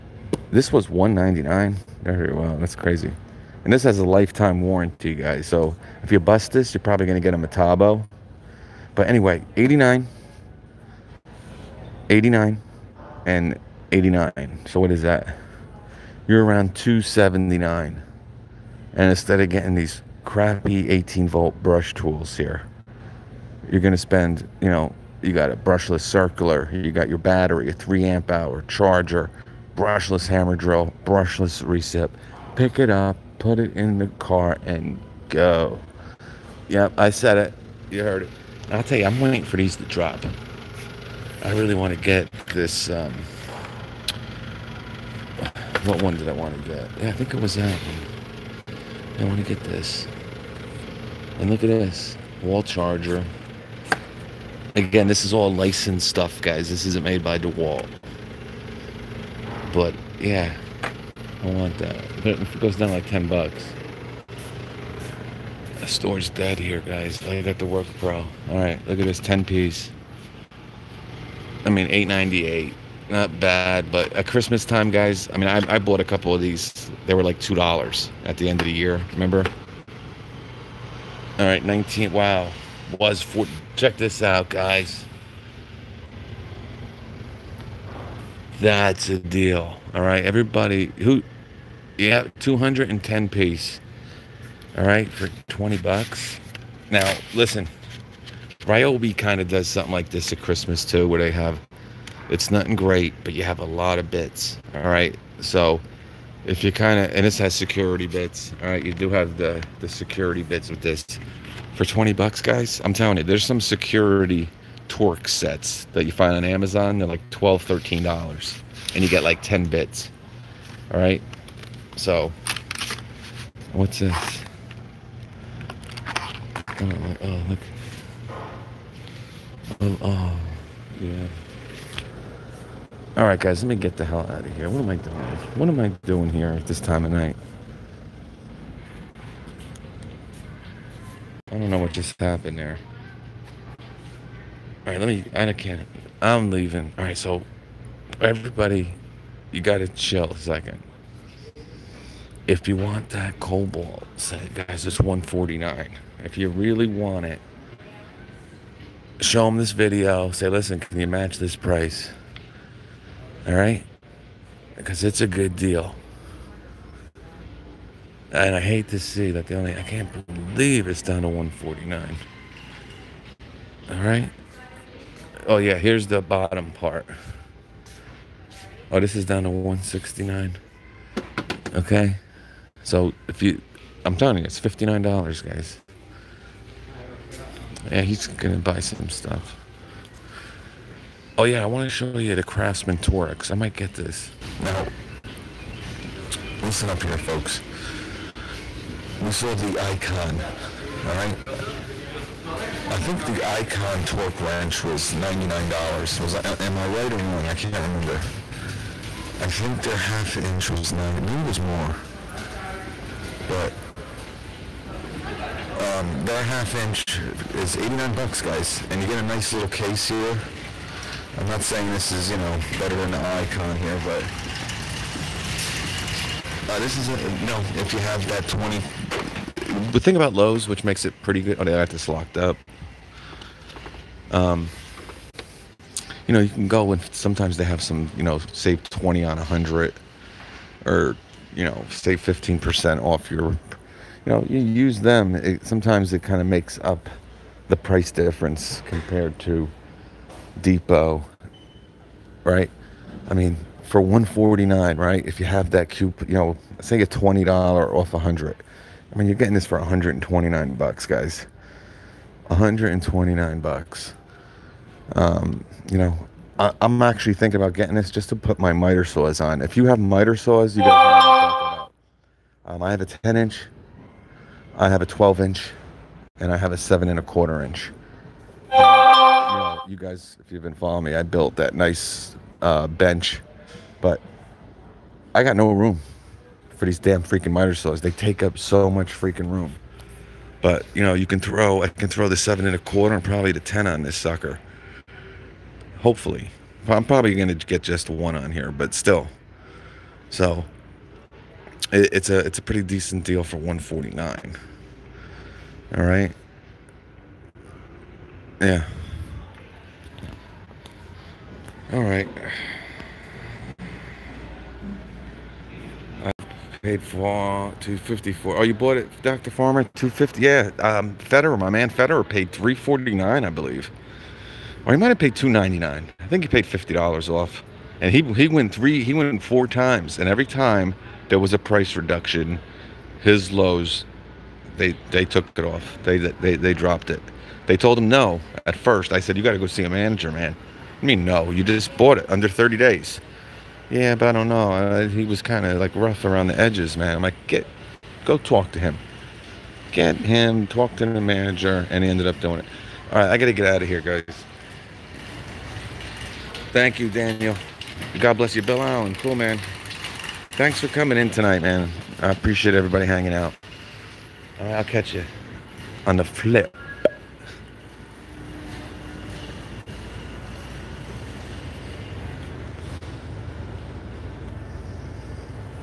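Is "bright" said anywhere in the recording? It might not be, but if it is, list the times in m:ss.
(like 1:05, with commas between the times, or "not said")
not said.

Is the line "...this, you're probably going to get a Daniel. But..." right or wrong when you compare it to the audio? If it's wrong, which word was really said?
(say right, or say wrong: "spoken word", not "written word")
wrong: "Metabo", not "Daniel".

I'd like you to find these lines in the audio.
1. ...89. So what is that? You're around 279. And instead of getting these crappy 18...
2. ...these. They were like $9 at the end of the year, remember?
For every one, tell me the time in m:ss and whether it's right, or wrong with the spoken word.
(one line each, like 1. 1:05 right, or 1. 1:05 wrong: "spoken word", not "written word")
1. 0:13 right
2. 1:16 wrong: "2", not "9".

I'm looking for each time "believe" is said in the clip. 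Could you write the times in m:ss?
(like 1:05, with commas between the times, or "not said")
2:50, 5:23.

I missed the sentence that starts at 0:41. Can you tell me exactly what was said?
I really want to get this.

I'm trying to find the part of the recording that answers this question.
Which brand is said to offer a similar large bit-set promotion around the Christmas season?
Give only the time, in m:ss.
1:38.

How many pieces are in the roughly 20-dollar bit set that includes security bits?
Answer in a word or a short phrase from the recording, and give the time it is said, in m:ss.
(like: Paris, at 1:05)
210, at 1:32.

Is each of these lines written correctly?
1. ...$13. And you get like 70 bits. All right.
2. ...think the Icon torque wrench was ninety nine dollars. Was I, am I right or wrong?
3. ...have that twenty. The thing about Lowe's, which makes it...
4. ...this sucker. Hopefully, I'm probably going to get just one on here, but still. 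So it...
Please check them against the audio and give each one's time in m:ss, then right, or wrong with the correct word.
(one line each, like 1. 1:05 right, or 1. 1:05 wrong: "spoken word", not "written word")
1. 1:57 wrong: "10", not "70"
2. 3:22 right
3. 3:48 right
4. 4:54 right.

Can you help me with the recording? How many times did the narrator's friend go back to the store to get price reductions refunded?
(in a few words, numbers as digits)
4.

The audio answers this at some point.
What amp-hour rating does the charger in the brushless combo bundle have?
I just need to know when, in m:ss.
0:27.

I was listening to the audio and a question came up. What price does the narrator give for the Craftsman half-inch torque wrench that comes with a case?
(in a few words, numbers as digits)
$89.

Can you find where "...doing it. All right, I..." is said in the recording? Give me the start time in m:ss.
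5:52.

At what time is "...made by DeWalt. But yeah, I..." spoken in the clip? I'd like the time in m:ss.
0:57.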